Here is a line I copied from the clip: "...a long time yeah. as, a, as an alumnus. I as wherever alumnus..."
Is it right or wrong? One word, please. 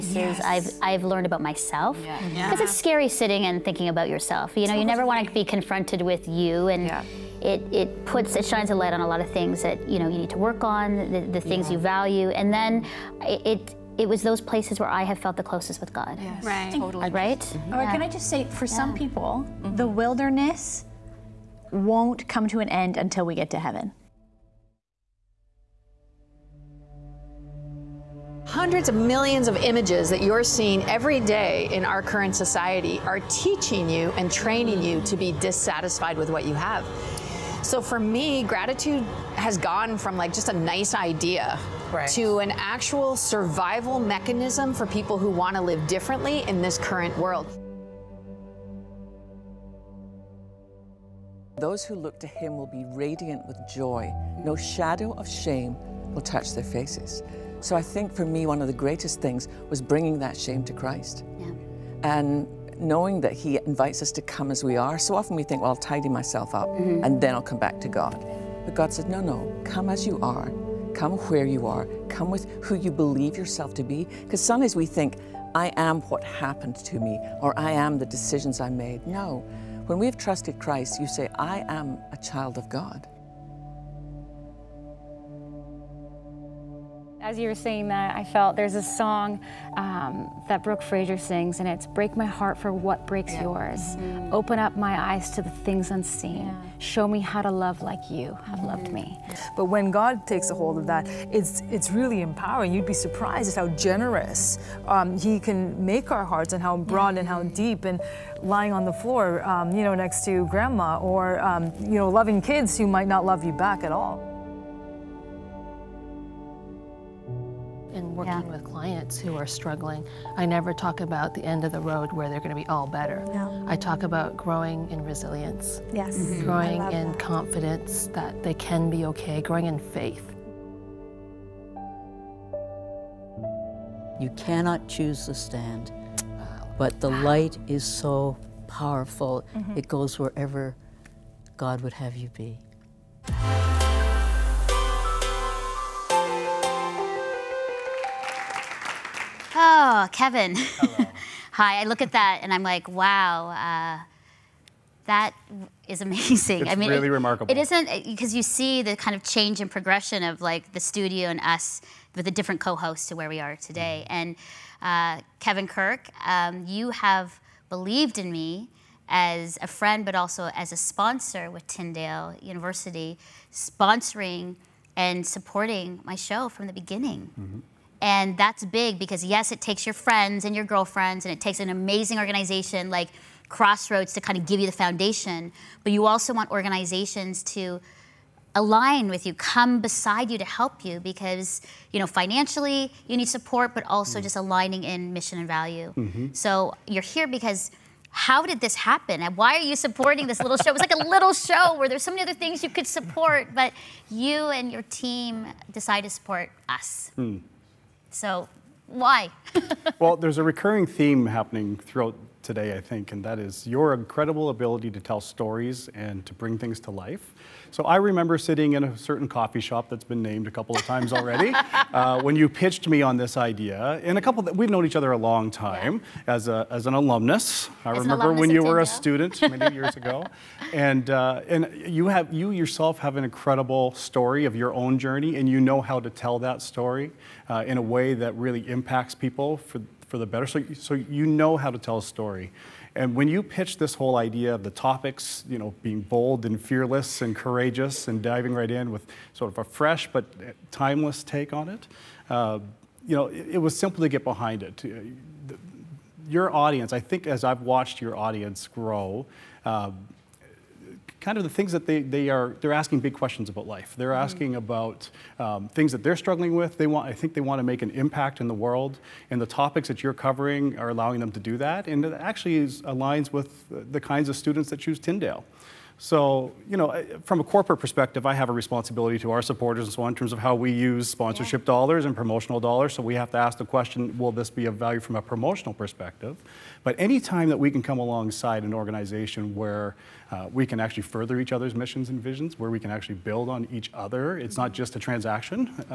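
wrong.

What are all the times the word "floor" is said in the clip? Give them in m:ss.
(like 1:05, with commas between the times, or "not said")
1:49.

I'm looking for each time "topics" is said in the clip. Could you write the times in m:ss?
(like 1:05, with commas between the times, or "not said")
4:04, 4:29.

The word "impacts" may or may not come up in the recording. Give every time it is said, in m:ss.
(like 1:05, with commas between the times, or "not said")
3:58, 4:28.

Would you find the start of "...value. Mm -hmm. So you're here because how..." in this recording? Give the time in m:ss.
3:15.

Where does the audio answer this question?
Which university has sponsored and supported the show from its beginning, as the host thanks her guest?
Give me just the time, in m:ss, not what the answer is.
2:51.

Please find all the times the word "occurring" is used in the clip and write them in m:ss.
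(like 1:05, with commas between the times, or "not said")
not said.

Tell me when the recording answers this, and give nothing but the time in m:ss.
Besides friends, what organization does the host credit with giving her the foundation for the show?
3:03.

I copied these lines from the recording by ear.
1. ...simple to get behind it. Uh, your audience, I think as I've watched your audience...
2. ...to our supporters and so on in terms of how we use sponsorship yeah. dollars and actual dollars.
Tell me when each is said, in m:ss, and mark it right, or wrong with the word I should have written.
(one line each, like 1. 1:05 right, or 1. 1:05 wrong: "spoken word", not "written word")
1. 4:13 right
2. 4:39 wrong: "promotional", not "actual".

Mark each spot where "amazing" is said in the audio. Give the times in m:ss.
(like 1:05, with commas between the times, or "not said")
2:36, 3:01.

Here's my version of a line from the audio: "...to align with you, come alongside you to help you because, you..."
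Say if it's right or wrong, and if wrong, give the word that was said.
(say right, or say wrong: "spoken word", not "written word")
wrong: "beside", not "alongside".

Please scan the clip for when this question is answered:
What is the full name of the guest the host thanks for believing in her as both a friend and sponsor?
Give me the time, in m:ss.
2:45.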